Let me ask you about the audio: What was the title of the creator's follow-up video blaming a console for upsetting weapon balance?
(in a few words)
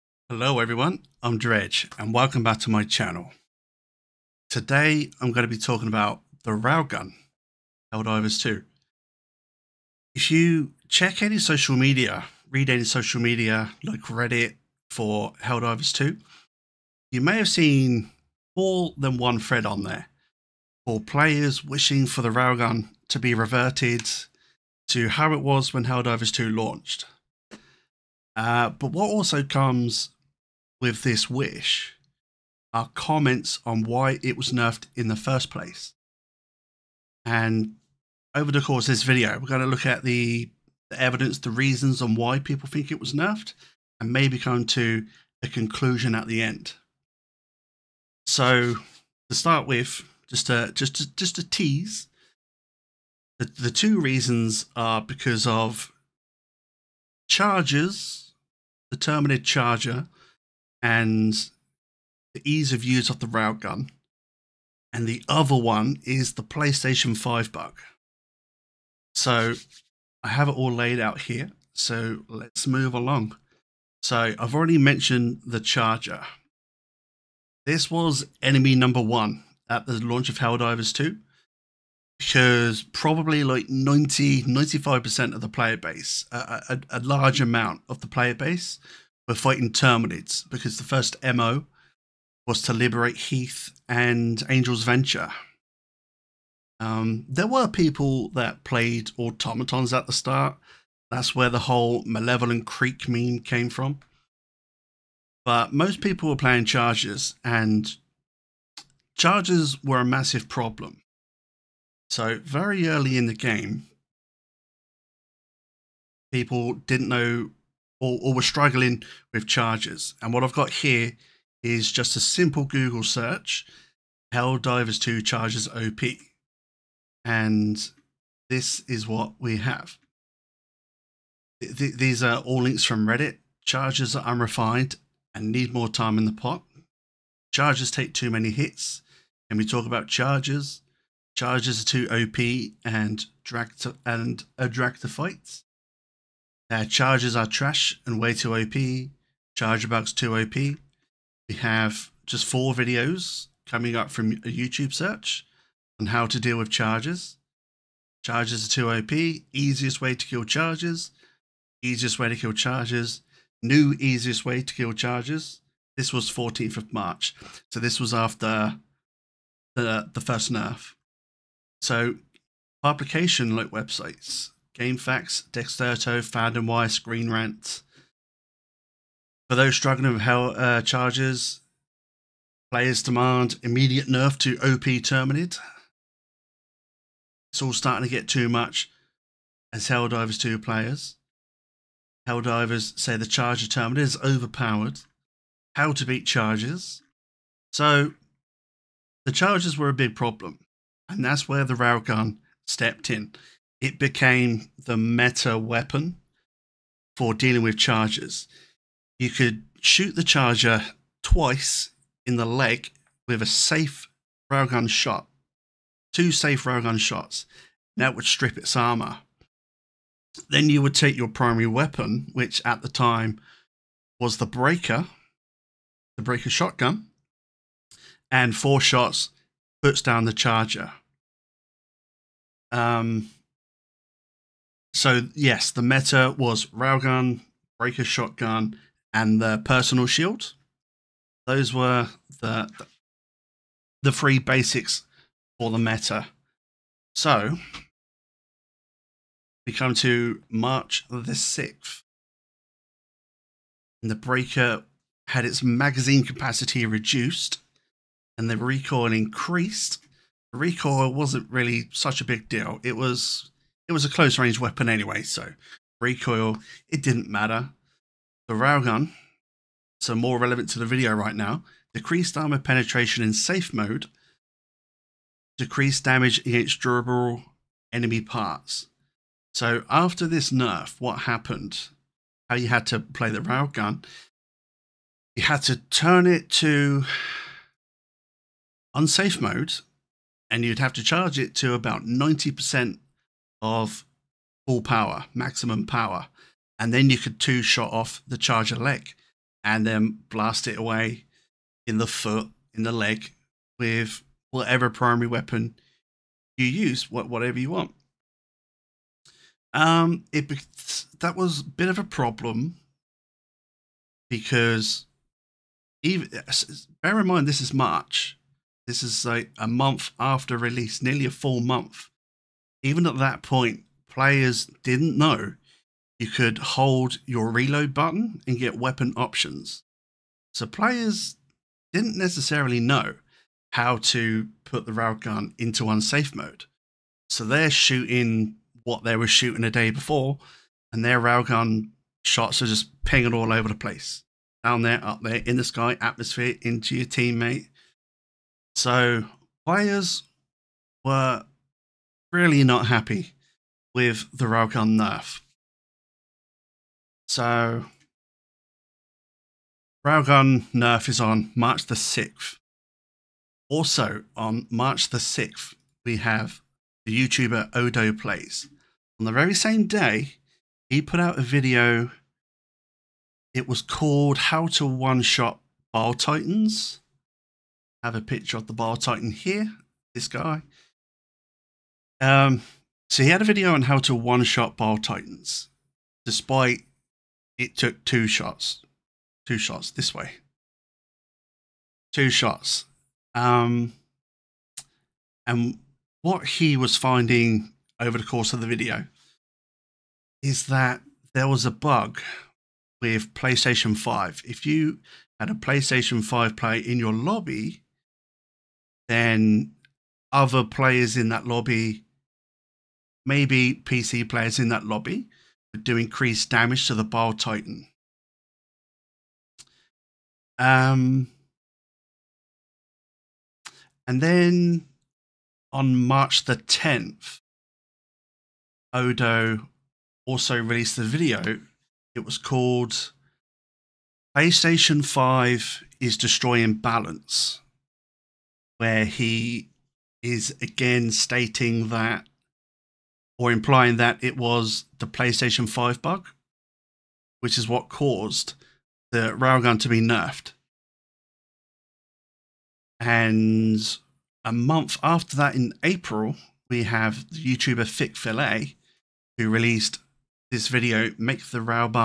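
PlayStation 5 is Destroying Balance.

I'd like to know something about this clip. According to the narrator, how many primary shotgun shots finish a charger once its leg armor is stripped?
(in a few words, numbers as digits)
4.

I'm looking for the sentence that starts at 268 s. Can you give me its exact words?
The railgun, so more relevant to the video right now, decreased armor penetration in safe mode, decreased damage against durable enemy parts.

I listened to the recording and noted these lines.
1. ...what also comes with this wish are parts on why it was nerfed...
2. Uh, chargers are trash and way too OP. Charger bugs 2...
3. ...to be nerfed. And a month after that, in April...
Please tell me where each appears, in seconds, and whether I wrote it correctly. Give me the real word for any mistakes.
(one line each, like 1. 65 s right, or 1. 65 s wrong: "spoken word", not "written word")
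1. 28 s wrong: "comments", not "parts"
2. 146 s right
3. 449 s right.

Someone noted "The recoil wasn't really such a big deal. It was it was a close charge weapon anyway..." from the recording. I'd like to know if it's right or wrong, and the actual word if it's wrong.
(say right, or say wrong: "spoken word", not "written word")
wrong: "range", not "charge".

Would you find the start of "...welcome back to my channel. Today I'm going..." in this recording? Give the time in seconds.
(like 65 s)
2 s.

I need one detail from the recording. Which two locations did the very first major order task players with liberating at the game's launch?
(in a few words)
Heeth and Angel's Venture.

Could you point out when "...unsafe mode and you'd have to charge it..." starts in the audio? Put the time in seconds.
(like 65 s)
288 s.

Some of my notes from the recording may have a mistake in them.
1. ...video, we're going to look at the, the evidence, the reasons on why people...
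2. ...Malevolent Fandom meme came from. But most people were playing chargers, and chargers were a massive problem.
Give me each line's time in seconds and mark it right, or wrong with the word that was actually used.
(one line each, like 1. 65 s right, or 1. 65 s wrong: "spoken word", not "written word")
1. 39 s right
2. 102 s wrong: "Creek", not "Fandom".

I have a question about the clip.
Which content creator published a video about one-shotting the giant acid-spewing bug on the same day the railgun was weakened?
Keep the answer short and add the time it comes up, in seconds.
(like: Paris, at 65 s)
Odo Plays, at 367 s.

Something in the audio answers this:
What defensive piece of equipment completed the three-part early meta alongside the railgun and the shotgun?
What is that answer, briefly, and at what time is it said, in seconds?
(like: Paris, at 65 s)
personal shield, at 239 s.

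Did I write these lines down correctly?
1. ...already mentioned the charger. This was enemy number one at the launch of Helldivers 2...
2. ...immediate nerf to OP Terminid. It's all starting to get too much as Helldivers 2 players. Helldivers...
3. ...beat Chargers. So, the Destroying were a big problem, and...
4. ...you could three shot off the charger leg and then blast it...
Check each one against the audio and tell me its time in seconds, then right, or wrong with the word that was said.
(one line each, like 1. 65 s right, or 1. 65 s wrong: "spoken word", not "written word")
1. 74 s right
2. 183 s right
3. 196 s wrong: "Chargers", not "Destroying"
4. 297 s wrong: "two", not "three".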